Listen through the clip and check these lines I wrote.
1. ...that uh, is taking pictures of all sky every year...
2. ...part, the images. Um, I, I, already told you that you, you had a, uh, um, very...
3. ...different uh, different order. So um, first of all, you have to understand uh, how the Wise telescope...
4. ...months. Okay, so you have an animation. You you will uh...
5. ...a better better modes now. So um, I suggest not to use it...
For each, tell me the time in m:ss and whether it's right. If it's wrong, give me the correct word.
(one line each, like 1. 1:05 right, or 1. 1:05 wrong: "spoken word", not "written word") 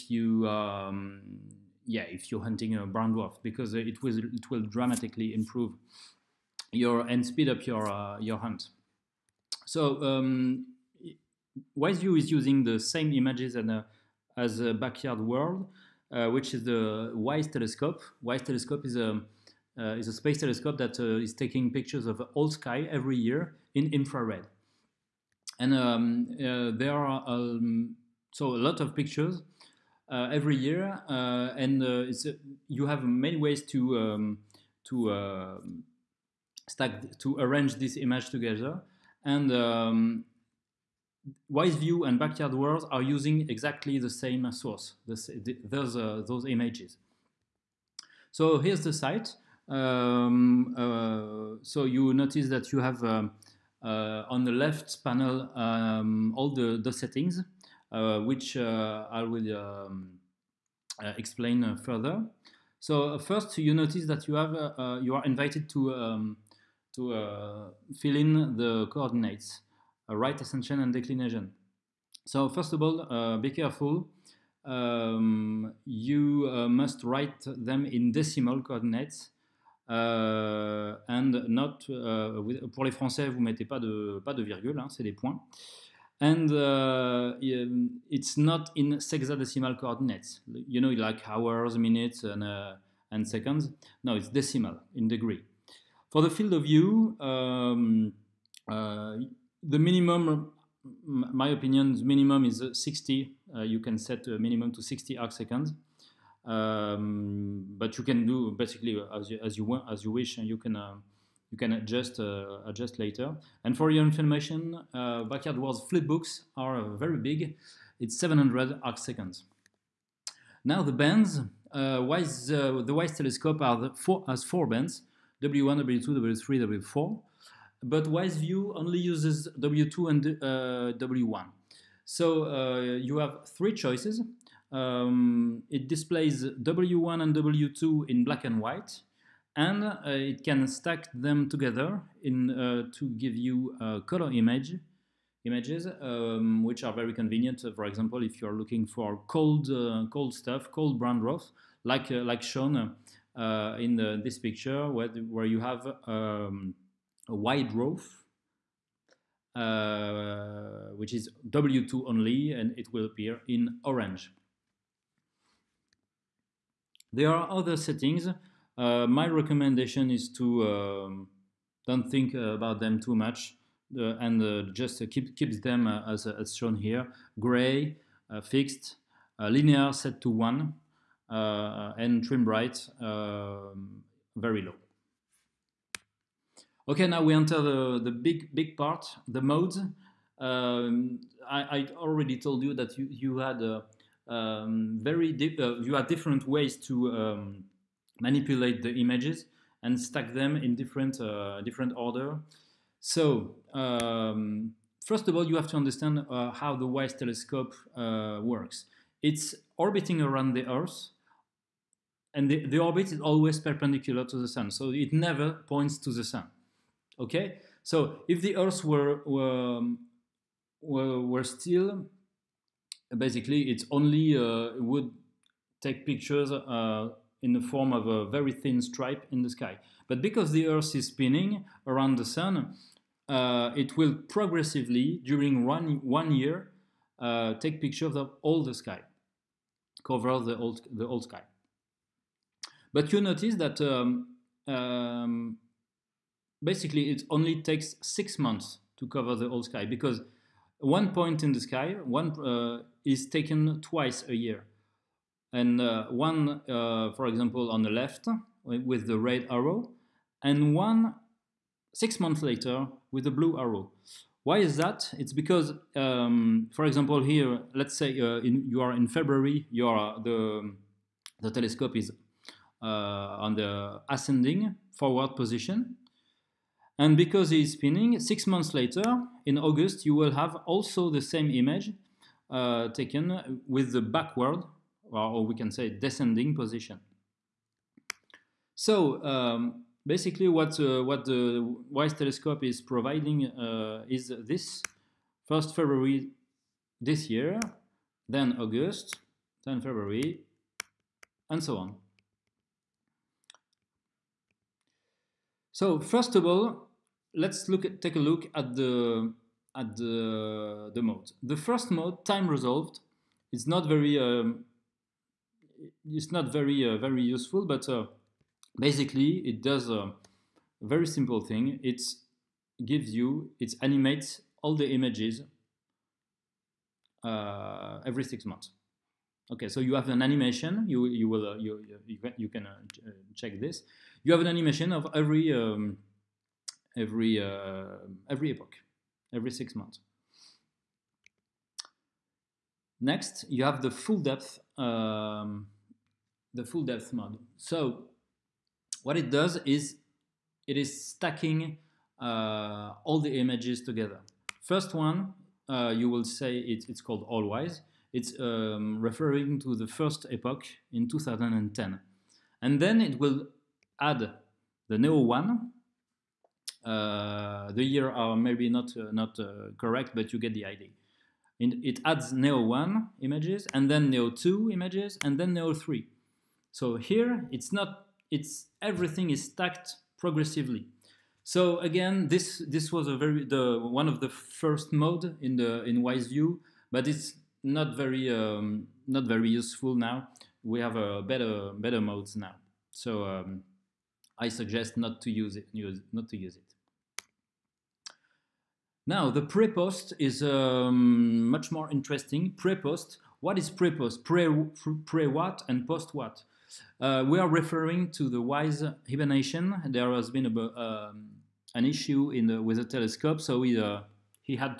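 1. 0:20 right
2. 3:08 wrong: "modes", not "images"
3. 3:20 right
4. 5:28 right
5. 6:30 right.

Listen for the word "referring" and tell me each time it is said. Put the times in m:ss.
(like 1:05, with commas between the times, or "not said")
5:59, 6:47.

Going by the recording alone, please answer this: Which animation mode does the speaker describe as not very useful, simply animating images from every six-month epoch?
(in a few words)
time resolved.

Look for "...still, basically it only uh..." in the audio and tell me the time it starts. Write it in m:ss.
3:41.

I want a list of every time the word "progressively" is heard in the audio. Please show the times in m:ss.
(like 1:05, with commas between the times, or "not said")
3:54, 6:20.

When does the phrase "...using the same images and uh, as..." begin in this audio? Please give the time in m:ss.
0:12.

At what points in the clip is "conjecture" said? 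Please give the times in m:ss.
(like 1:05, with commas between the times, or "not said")
not said.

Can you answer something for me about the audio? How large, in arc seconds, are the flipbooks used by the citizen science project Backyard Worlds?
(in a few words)
700.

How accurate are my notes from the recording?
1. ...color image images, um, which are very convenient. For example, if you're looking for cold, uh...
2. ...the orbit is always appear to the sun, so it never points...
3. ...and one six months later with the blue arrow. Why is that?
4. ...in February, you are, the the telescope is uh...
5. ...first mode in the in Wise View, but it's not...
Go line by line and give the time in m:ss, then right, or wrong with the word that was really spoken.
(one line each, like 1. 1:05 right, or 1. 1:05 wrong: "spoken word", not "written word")
1. 2:24 right
2. 3:32 wrong: "perpendicular", not "appear"
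3. 4:20 right
4. 4:28 right
5. 6:24 right.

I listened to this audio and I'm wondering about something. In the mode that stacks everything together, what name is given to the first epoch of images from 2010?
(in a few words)
AllWISE.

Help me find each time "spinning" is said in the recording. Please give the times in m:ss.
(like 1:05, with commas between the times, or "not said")
3:51, 4:37.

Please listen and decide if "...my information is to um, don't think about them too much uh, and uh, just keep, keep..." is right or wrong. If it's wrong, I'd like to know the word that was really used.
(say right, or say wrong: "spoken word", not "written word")
wrong: "recommendation", not "information".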